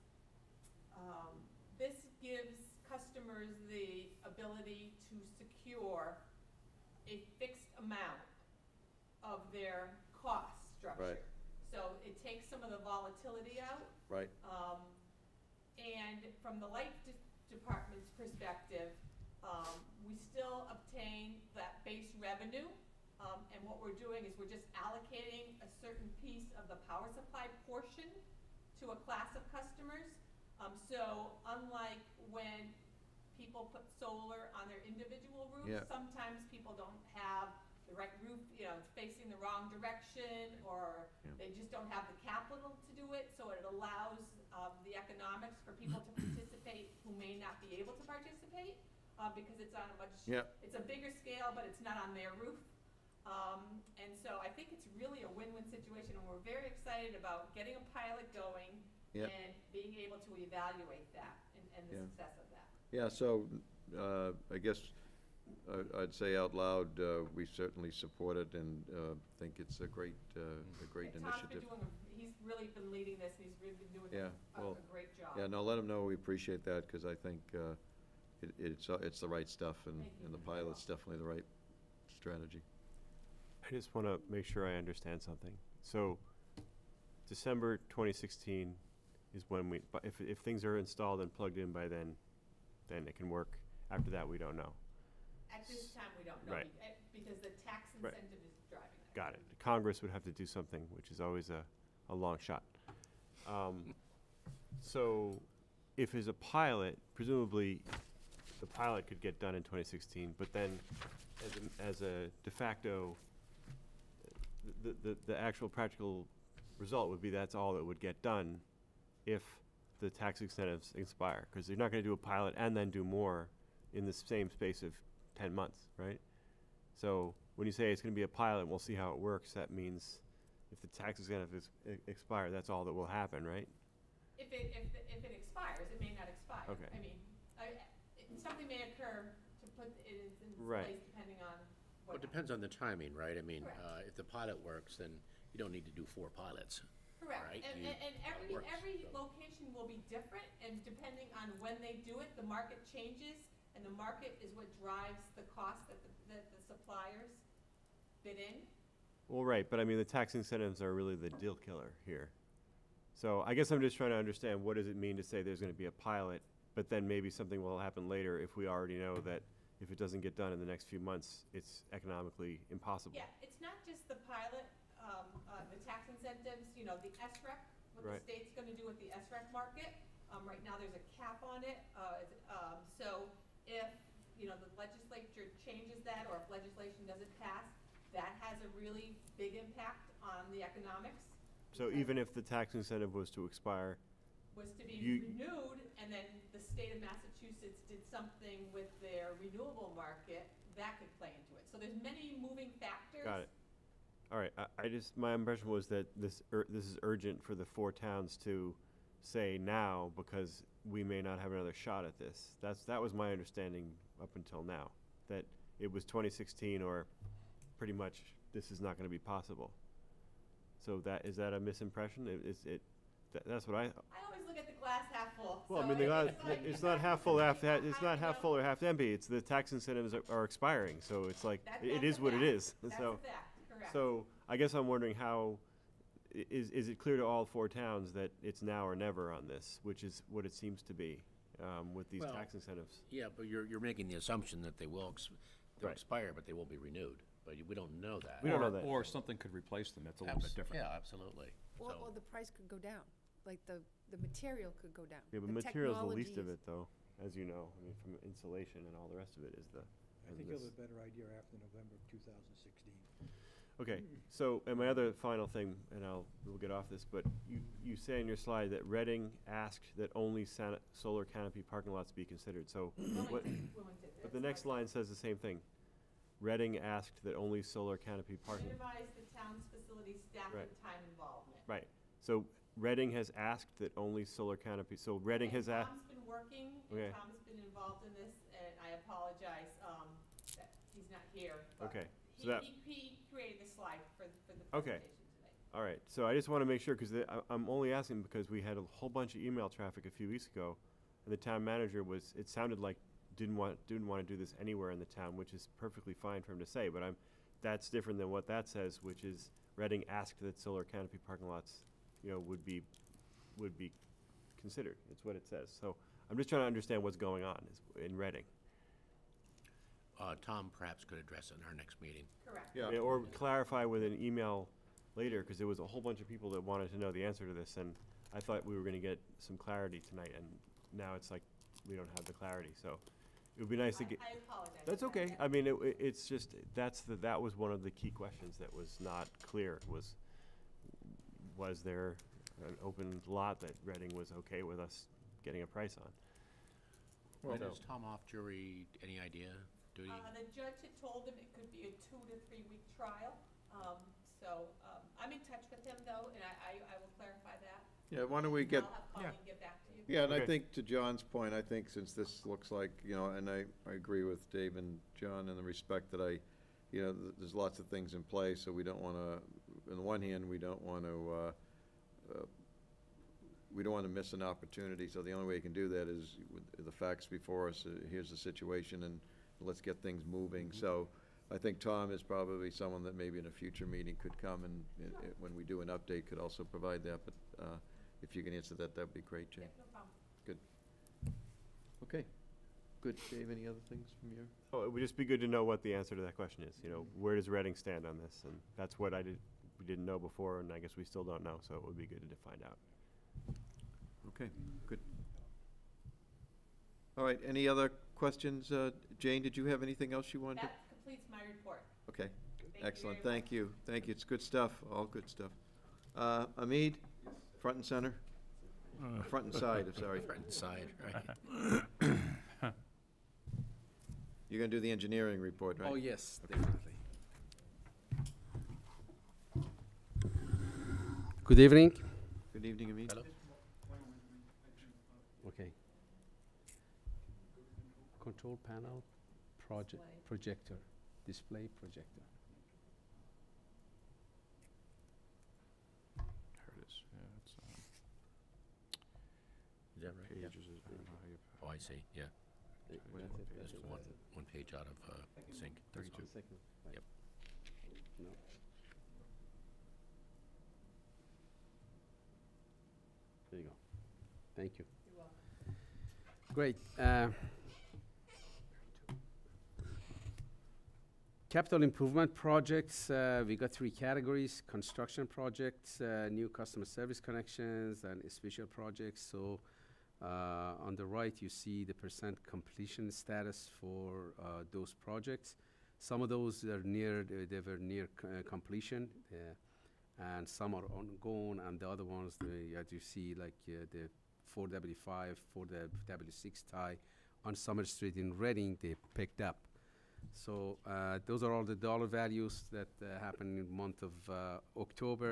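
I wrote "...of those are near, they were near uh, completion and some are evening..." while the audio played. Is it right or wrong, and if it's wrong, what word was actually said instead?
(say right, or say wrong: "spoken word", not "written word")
wrong: "ongoing", not "evening".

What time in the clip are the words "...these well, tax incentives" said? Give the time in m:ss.
4:02.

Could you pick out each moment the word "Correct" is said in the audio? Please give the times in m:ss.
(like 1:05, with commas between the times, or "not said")
2:27, 5:22.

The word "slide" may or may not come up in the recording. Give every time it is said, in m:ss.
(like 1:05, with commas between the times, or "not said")
4:28, 4:53.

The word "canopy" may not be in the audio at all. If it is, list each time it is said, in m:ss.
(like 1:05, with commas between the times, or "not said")
4:31, 4:37, 4:44, 5:10.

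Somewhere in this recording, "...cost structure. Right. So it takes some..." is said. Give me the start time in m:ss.
0:10.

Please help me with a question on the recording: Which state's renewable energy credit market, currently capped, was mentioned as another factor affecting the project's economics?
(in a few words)
Massachusetts.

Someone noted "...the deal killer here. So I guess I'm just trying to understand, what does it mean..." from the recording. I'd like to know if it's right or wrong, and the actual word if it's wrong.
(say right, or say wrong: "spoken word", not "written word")
right.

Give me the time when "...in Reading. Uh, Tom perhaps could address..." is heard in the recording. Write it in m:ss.
5:18.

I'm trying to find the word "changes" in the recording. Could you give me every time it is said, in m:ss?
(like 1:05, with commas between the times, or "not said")
2:32, 3:05.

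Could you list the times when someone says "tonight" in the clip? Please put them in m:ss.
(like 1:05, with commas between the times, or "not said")
5:30.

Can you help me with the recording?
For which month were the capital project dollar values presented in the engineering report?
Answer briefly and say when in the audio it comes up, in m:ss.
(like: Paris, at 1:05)
October, at 8:24.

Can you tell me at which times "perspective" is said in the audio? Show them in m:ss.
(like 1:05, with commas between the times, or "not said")
0:18.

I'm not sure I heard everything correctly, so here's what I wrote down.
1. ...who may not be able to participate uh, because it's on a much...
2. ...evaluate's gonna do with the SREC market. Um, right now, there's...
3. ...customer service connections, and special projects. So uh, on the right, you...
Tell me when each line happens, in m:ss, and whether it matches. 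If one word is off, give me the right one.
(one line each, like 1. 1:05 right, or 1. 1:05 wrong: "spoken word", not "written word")
1. 0:47 right
2. 2:58 wrong: "state", not "evaluate"
3. 7:56 right.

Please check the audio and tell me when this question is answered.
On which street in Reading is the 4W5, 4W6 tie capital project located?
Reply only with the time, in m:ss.
8:17.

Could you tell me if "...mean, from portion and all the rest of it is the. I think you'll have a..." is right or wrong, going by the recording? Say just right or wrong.
wrong.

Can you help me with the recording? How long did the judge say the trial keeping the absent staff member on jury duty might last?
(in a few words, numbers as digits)
2 to 3 weeks.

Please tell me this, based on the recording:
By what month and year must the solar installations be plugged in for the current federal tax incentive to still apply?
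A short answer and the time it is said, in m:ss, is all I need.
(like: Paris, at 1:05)
December 2016, at 1:27.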